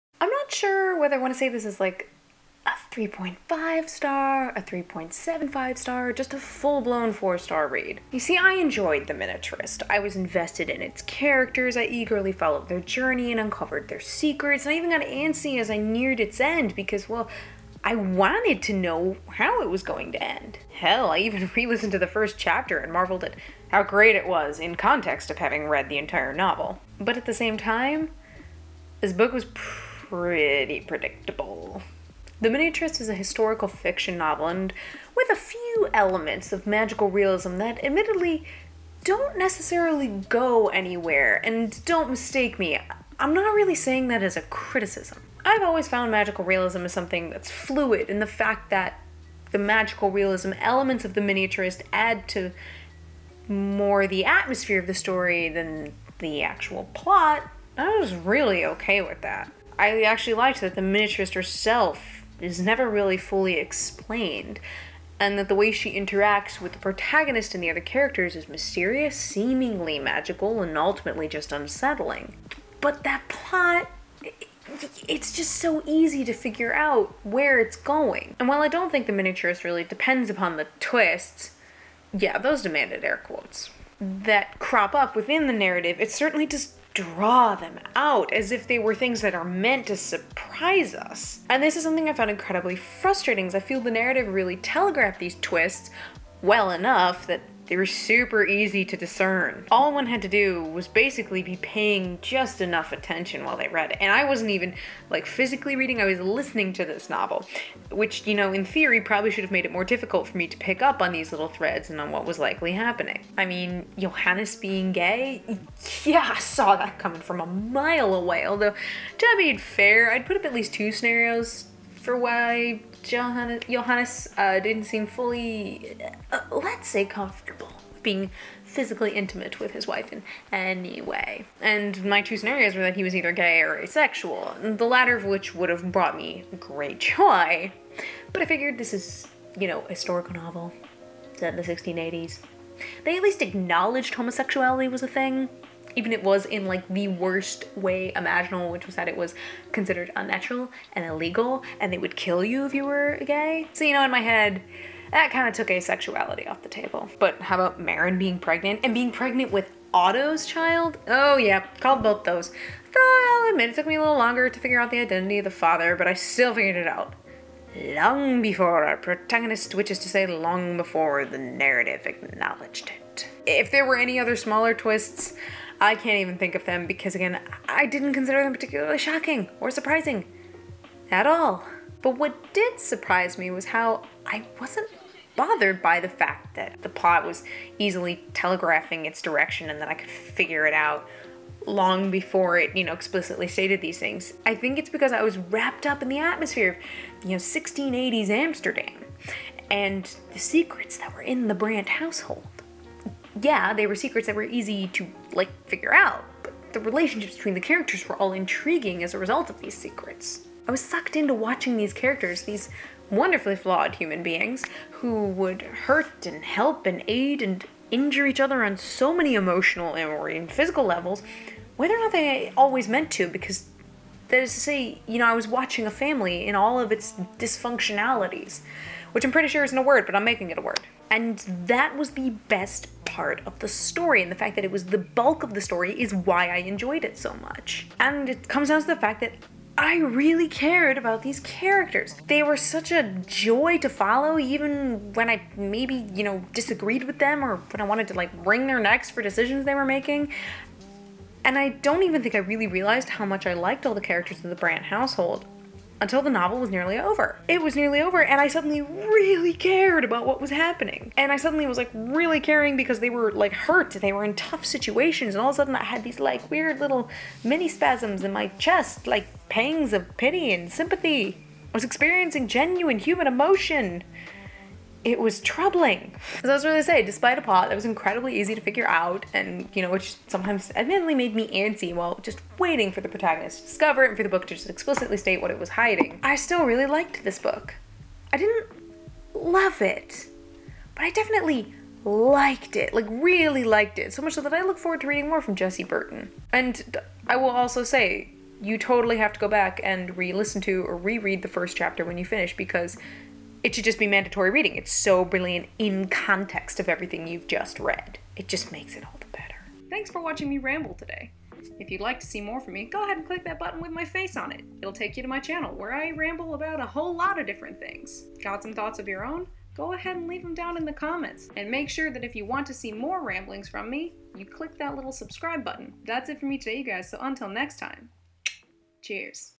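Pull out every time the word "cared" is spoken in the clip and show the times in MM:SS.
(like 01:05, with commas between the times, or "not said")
04:00, 04:19.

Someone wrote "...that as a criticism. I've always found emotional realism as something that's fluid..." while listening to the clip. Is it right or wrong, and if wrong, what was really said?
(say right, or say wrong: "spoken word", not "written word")
wrong: "magical", not "emotional".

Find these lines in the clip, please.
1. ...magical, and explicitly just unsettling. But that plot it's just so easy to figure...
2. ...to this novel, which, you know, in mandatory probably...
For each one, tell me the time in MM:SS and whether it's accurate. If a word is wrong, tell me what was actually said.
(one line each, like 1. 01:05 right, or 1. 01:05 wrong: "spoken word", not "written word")
1. 01:09 wrong: "ultimately", not "explicitly"
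2. 01:46 wrong: "theory", not "mandatory".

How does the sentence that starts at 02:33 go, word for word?
So, you know, in my head, that kind of took asexuality off the table.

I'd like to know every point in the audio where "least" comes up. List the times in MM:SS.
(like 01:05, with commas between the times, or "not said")
02:00, 02:23.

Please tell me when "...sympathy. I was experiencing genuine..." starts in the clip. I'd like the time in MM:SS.
04:30.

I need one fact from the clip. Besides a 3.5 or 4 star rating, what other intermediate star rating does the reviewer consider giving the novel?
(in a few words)
3.75.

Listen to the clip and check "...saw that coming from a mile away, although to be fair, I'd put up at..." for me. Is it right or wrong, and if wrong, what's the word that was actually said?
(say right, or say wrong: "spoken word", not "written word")
right.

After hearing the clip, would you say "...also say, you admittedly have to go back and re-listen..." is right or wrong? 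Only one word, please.
wrong.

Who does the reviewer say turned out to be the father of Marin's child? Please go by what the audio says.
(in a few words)
Otto.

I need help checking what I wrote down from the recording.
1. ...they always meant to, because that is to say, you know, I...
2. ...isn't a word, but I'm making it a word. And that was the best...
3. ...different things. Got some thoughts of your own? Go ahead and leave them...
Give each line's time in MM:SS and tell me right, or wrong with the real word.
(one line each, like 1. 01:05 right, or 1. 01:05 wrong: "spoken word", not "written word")
1. 03:42 right
2. 03:49 right
3. 05:17 right.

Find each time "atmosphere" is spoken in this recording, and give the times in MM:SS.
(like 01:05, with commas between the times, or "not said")
00:54, 03:16.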